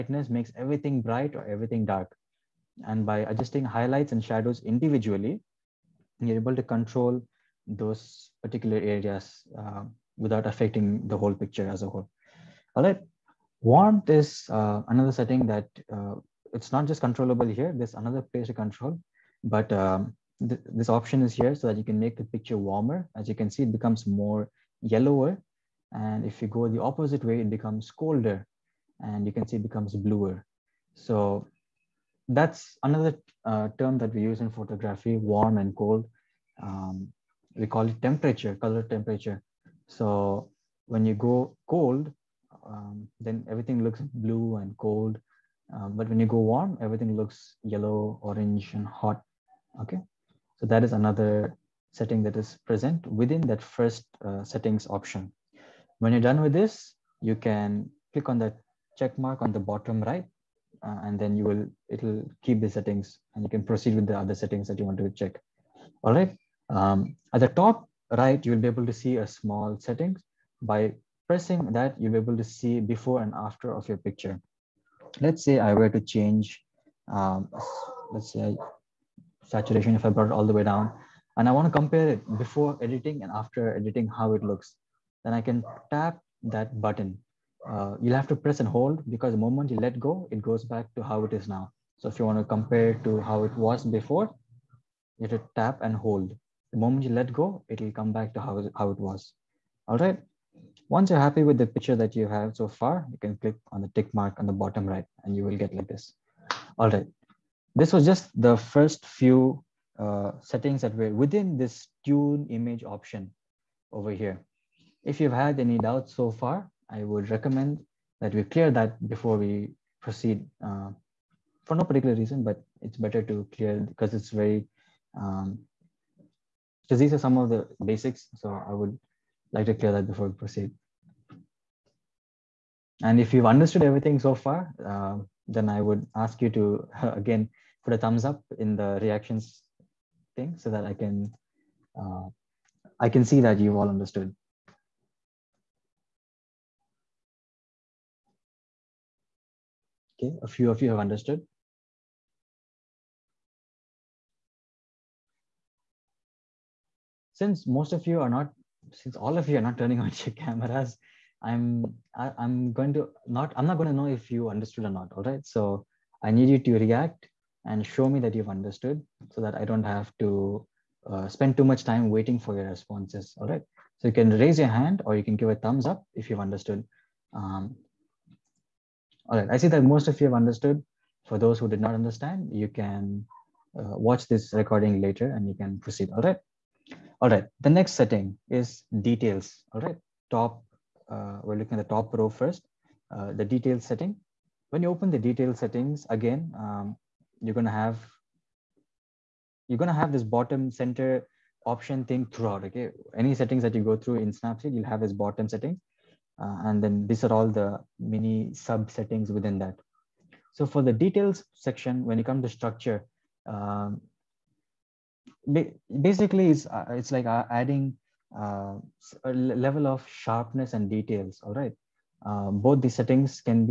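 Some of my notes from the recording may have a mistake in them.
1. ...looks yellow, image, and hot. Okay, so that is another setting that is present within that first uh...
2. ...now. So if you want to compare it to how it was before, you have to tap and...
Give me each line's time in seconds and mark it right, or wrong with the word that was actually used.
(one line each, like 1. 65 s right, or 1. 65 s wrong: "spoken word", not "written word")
1. 47 s wrong: "orange", not "image"
2. 91 s right.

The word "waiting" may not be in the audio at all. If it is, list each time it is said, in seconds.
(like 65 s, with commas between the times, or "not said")
172 s.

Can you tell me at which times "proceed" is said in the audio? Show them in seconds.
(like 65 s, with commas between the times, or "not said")
63 s, 119 s, 130 s, 185 s.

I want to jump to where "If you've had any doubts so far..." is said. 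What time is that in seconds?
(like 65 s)
115 s.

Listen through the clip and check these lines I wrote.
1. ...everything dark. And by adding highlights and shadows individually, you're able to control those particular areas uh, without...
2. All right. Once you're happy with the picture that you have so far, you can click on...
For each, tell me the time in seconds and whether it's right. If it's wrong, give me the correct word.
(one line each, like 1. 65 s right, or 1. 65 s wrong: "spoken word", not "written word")
1. 1 s wrong: "adjusting", not "adding"
2. 99 s right.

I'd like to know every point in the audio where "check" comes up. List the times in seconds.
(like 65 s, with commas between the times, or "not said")
58 s, 65 s.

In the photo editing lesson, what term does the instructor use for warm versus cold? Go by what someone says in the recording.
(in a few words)
color temperature.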